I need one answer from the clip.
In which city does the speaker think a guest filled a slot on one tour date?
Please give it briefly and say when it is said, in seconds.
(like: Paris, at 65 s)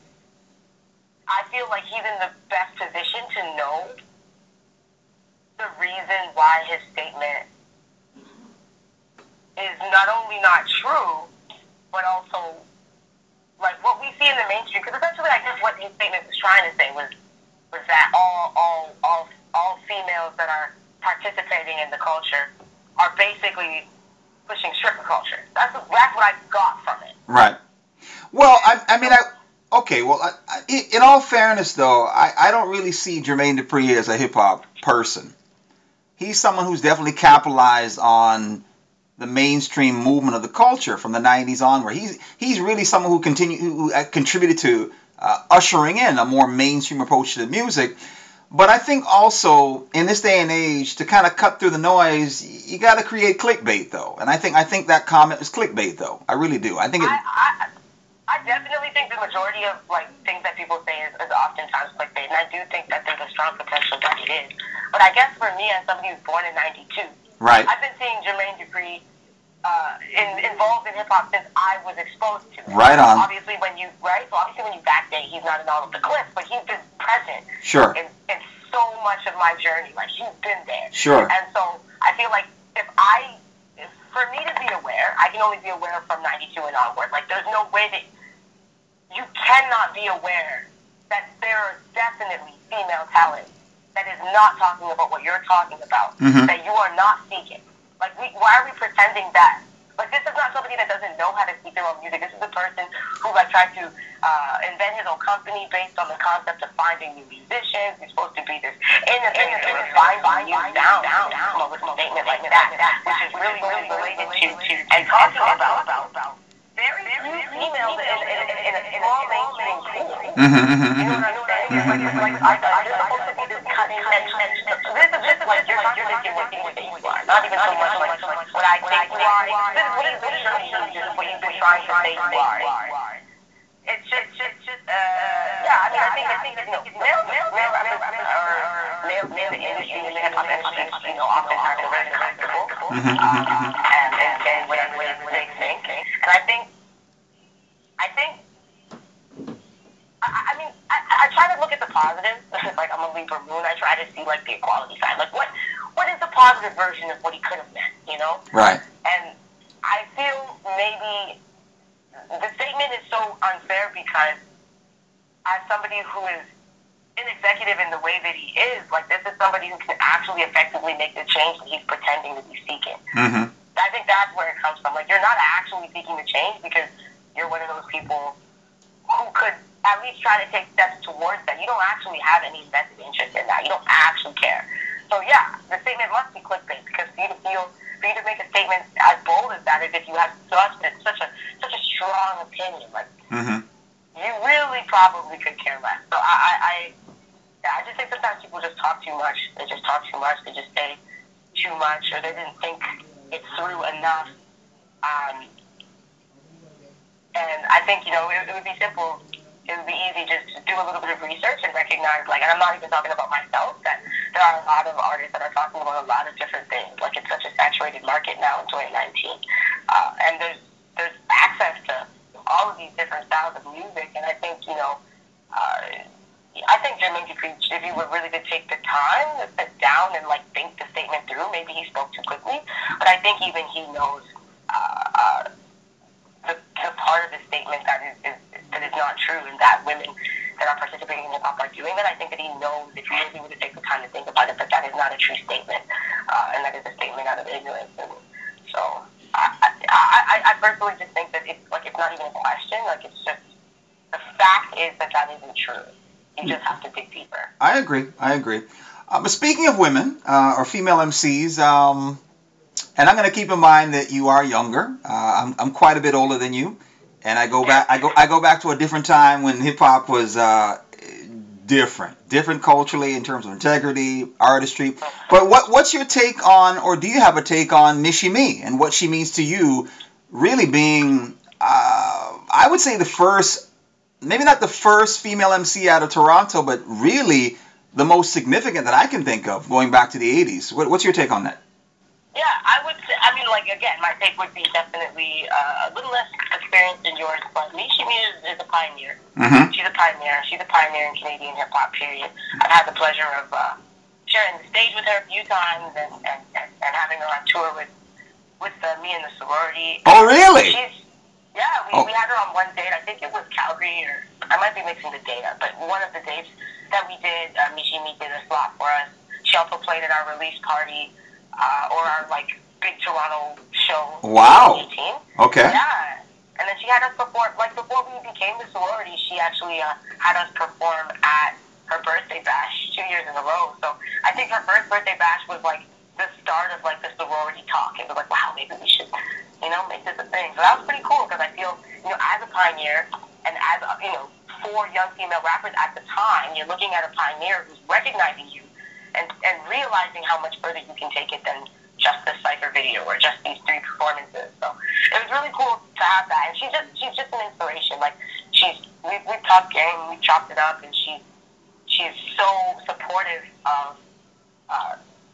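Calgary, at 313 s.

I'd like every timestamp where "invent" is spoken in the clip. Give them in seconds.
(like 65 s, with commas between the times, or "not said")
104 s.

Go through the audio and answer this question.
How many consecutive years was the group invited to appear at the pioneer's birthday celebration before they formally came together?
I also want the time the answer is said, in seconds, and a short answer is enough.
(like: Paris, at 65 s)
2, at 332 s.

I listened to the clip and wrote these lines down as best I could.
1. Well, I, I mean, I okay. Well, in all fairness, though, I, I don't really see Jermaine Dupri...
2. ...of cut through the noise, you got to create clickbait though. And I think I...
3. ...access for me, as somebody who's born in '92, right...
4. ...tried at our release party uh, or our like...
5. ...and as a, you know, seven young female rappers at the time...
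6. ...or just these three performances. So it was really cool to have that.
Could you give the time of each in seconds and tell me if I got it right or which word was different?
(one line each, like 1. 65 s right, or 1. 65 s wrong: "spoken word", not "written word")
1. 28 s right
2. 51 s right
3. 65 s wrong: "guess", not "access"
4. 319 s wrong: "played", not "tried"
5. 343 s wrong: "four", not "seven"
6. 353 s right.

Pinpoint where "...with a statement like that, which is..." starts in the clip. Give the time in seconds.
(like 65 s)
111 s.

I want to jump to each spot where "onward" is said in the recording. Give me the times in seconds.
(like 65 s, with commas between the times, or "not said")
41 s, 86 s.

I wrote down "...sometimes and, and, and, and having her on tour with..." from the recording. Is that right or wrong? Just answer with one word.
wrong.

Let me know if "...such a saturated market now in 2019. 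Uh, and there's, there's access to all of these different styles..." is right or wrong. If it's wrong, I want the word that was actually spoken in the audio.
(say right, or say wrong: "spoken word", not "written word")
right.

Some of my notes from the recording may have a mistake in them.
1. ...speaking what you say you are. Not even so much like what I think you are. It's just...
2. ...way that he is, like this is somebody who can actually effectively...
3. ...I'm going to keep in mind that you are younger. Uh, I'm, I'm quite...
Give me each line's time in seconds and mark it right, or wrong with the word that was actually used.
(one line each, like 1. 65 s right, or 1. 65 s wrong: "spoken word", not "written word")
1. 125 s wrong: "contradicting", not "speaking"
2. 167 s right
3. 263 s right.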